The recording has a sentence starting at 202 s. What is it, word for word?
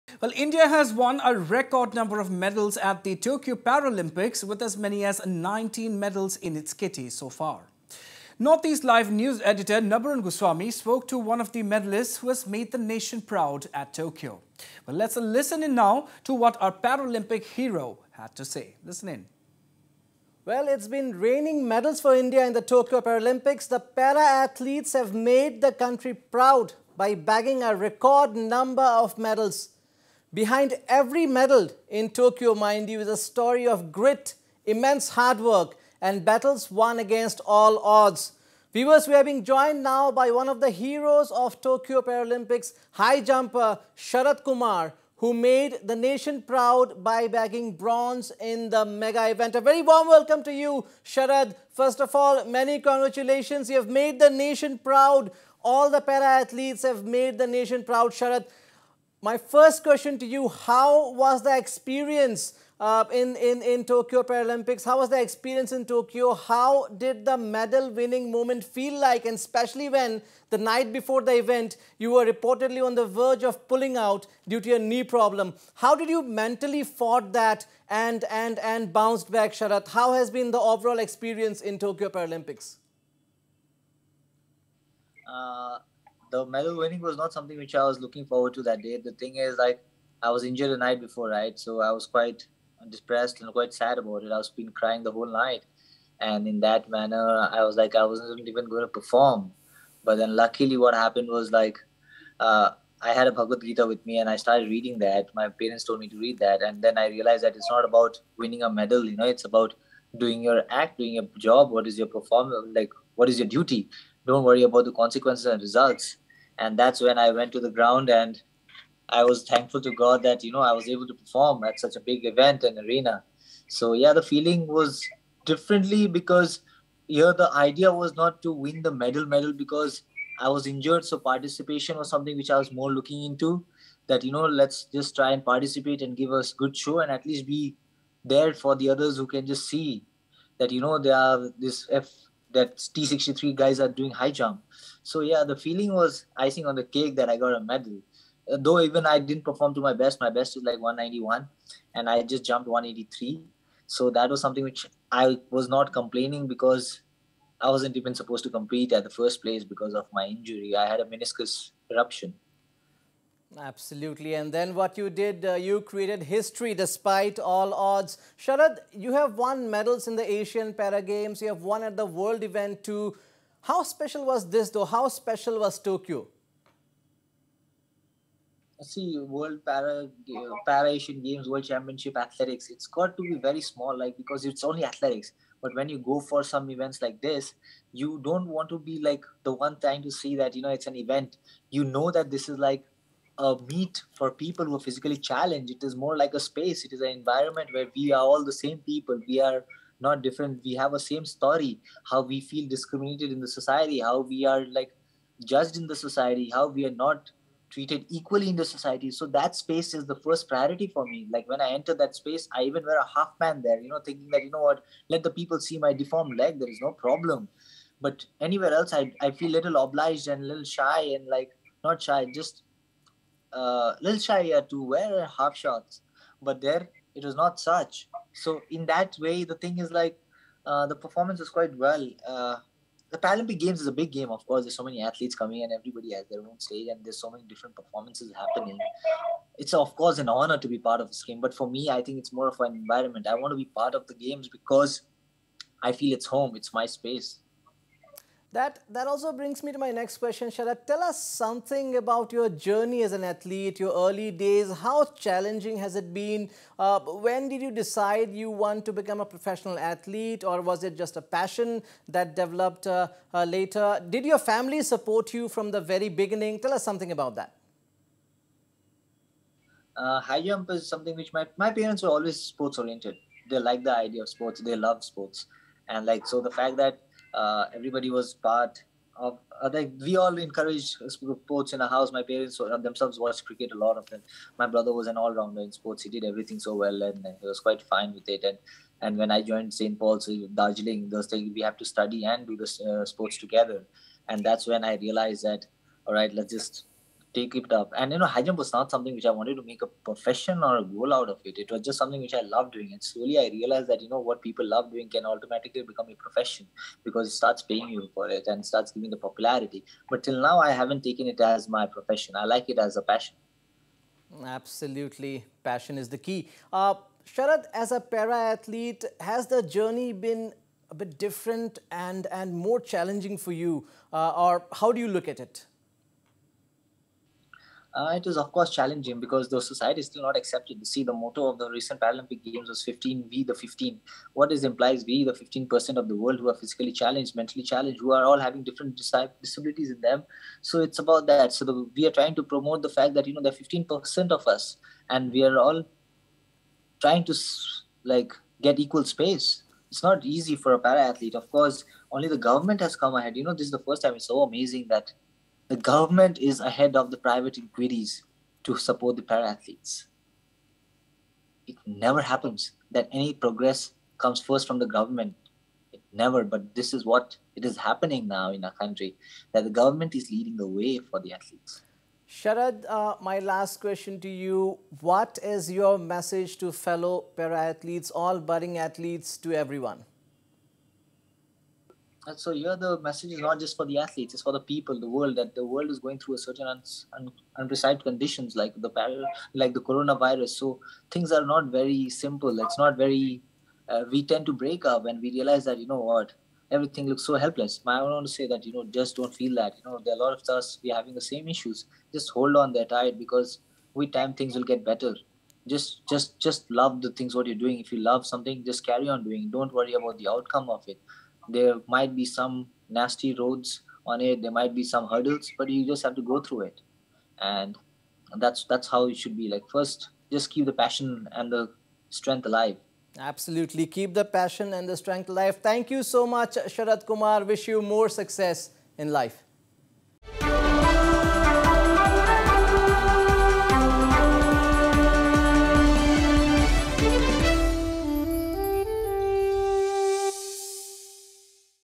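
How we feel discriminated in the society.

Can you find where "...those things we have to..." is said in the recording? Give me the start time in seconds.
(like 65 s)
291 s.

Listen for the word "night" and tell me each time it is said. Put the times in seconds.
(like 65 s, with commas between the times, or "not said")
70 s, 90 s, 95 s.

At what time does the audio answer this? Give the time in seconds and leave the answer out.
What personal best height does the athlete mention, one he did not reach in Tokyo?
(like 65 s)
150 s.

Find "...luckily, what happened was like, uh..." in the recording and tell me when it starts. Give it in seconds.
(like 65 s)
100 s.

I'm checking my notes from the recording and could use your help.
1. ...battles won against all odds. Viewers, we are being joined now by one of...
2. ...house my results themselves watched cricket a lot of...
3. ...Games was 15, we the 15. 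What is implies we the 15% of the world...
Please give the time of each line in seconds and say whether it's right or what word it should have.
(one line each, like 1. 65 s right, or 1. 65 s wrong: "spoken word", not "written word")
1. 36 s right
2. 281 s wrong: "parents", not "results"
3. 332 s right.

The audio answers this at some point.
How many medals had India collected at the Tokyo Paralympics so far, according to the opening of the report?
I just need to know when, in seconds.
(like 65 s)
5 s.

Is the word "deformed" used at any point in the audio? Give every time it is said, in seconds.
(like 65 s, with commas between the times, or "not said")
215 s.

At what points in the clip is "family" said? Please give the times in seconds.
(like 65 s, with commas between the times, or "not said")
264 s.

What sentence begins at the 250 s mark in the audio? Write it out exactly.
Sharad, tell us something about your journey as an athlete, your early days.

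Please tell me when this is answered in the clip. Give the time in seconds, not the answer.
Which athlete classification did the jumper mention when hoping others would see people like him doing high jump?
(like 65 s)
142 s.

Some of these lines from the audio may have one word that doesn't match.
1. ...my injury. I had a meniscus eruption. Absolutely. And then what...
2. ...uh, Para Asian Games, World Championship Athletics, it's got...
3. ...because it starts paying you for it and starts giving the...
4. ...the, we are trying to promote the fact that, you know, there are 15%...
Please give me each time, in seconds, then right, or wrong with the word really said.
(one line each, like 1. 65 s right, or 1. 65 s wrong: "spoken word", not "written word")
1. 160 s right
2. 180 s right
3. 307 s right
4. 341 s right.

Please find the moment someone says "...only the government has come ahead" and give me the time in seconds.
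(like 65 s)
352 s.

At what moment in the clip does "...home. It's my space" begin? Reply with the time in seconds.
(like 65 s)
246 s.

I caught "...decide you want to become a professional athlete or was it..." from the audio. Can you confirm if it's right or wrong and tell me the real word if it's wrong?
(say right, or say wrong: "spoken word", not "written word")
right.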